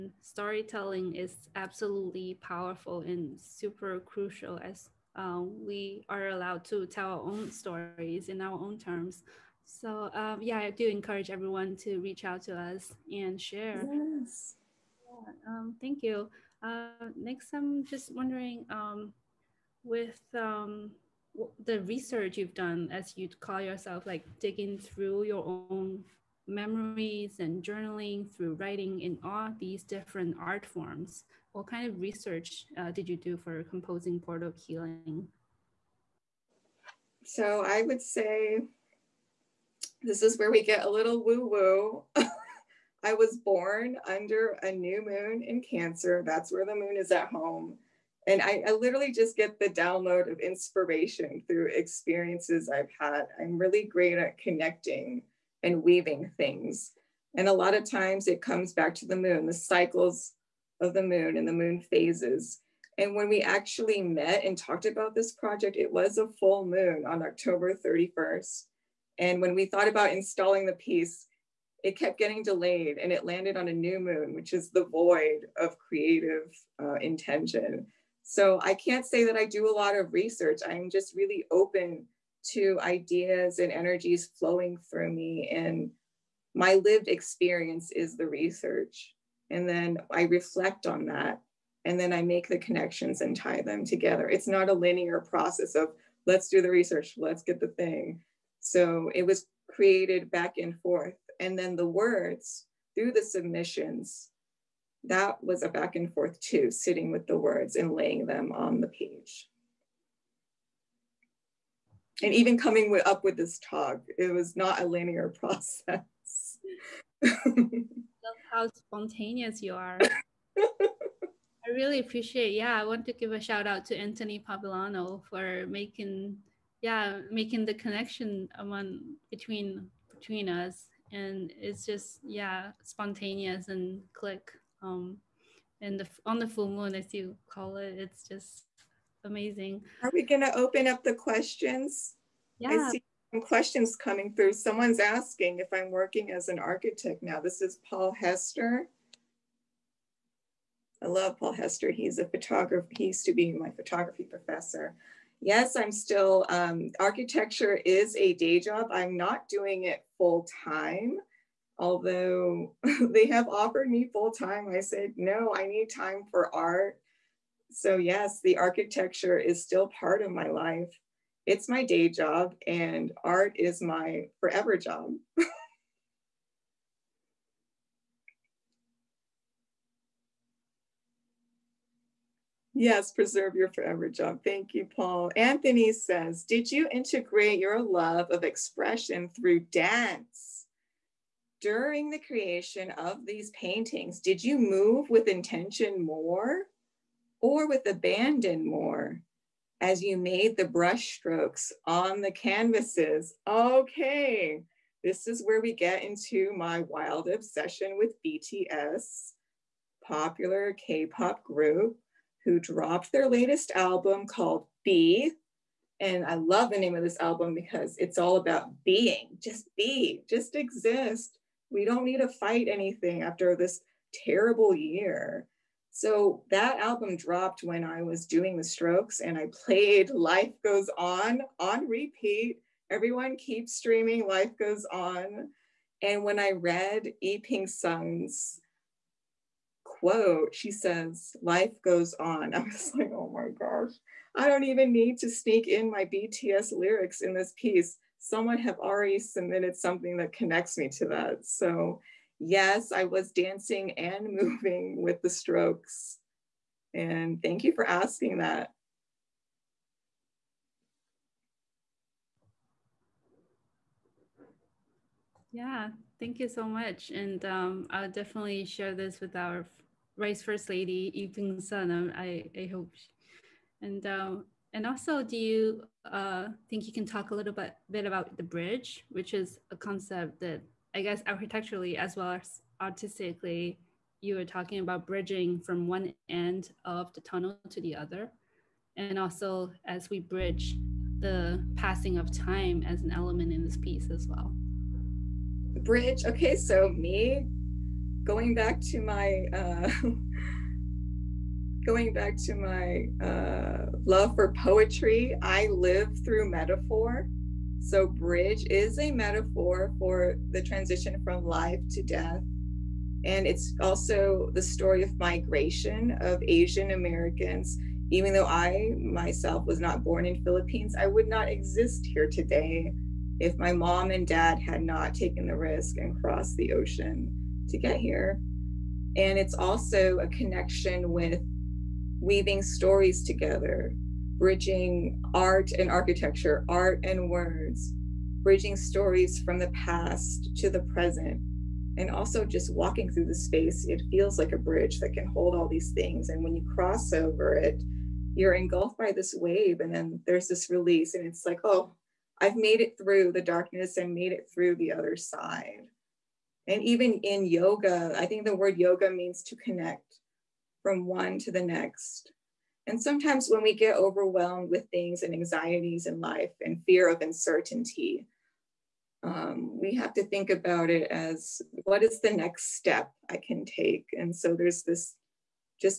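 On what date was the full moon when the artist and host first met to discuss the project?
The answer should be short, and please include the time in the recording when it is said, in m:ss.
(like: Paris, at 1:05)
October 31st, at 1:07.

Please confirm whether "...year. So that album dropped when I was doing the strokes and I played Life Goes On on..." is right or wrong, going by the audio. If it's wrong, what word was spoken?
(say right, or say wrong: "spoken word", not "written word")
right.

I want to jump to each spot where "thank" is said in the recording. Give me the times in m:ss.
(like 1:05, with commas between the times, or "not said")
0:15, 3:04, 4:17, 4:26.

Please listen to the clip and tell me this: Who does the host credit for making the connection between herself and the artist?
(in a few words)
Anthony Pabilano.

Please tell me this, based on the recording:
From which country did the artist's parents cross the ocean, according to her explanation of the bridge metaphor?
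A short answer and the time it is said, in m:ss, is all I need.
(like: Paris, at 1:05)
Philippines, at 5:20.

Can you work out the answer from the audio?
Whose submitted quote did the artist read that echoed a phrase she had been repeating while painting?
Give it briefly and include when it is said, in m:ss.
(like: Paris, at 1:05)
E. Ping Sung, at 3:57.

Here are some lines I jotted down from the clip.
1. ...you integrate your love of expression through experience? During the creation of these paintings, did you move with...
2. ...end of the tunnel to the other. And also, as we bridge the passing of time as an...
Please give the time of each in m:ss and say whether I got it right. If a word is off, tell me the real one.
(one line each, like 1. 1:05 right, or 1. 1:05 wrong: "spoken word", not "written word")
1. 3:06 wrong: "dance", not "experience"
2. 4:46 right.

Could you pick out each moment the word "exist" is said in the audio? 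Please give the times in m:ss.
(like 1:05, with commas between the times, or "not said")
3:40, 5:21.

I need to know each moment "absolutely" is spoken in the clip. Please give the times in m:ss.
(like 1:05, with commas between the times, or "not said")
0:01.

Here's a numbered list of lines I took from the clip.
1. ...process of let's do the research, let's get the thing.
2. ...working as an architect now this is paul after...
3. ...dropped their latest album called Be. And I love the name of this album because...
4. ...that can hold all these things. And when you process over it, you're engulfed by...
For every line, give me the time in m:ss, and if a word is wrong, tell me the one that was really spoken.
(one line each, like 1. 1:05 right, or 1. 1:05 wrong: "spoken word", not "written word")
1. 1:35 right
2. 2:25 wrong: "hester", not "after"
3. 3:32 right
4. 5:45 wrong: "cross", not "process".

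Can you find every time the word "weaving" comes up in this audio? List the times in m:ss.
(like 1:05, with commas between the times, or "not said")
0:55, 5:32.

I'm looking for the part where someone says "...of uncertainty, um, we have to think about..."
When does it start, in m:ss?
6:07.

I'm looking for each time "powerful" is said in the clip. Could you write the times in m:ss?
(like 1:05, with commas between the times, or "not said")
0:02.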